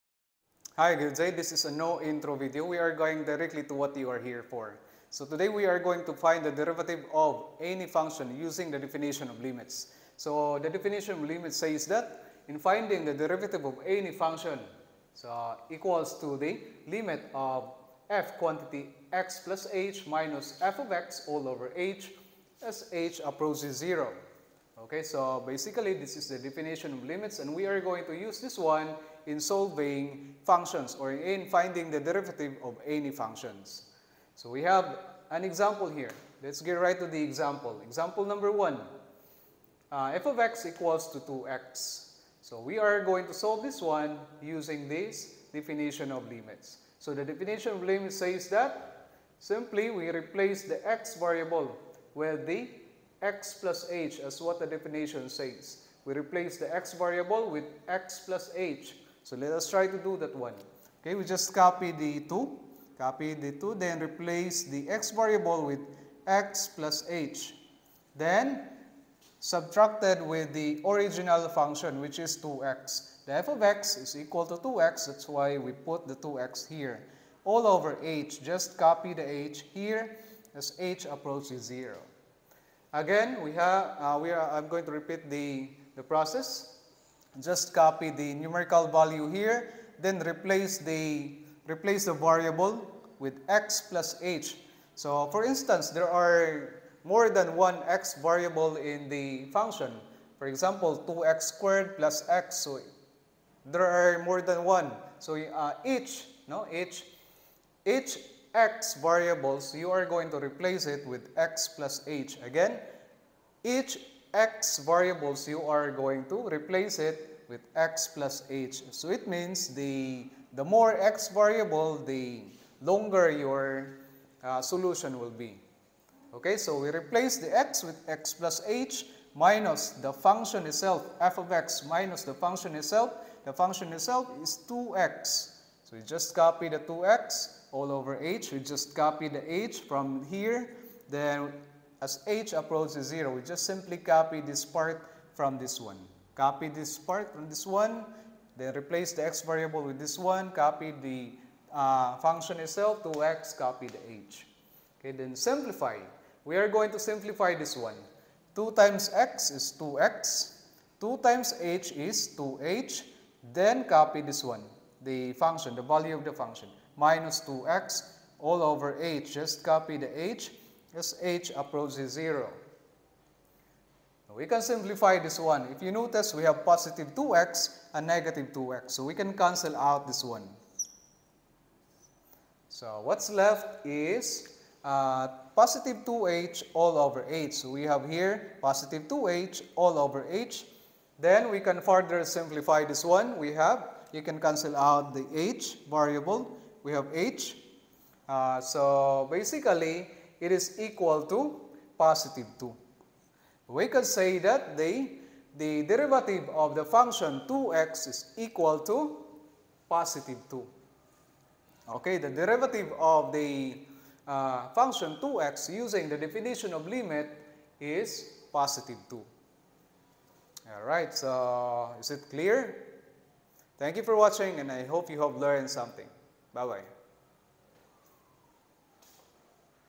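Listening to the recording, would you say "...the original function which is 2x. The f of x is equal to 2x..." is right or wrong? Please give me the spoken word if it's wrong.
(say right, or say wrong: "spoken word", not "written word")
right.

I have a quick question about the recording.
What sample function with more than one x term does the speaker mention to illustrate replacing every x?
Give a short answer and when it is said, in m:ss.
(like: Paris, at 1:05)
2x squared plus x, at 1:41.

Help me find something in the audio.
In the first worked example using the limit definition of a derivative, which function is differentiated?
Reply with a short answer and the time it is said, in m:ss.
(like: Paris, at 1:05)
2x, at 0:40.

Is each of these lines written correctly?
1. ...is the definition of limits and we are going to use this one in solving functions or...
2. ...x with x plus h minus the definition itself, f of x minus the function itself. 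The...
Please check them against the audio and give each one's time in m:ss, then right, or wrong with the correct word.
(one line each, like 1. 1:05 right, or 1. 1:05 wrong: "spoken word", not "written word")
1. 0:26 right
2. 2:07 wrong: "function", not "definition".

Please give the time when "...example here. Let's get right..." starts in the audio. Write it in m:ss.
0:35.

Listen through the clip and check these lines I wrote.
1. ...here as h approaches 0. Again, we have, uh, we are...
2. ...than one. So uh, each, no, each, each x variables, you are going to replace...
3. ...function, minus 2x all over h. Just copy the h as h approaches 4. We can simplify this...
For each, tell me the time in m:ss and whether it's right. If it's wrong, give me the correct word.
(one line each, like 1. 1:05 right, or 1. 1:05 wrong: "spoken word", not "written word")
1. 1:19 right
2. 1:44 right
3. 2:46 wrong: "0", not "4".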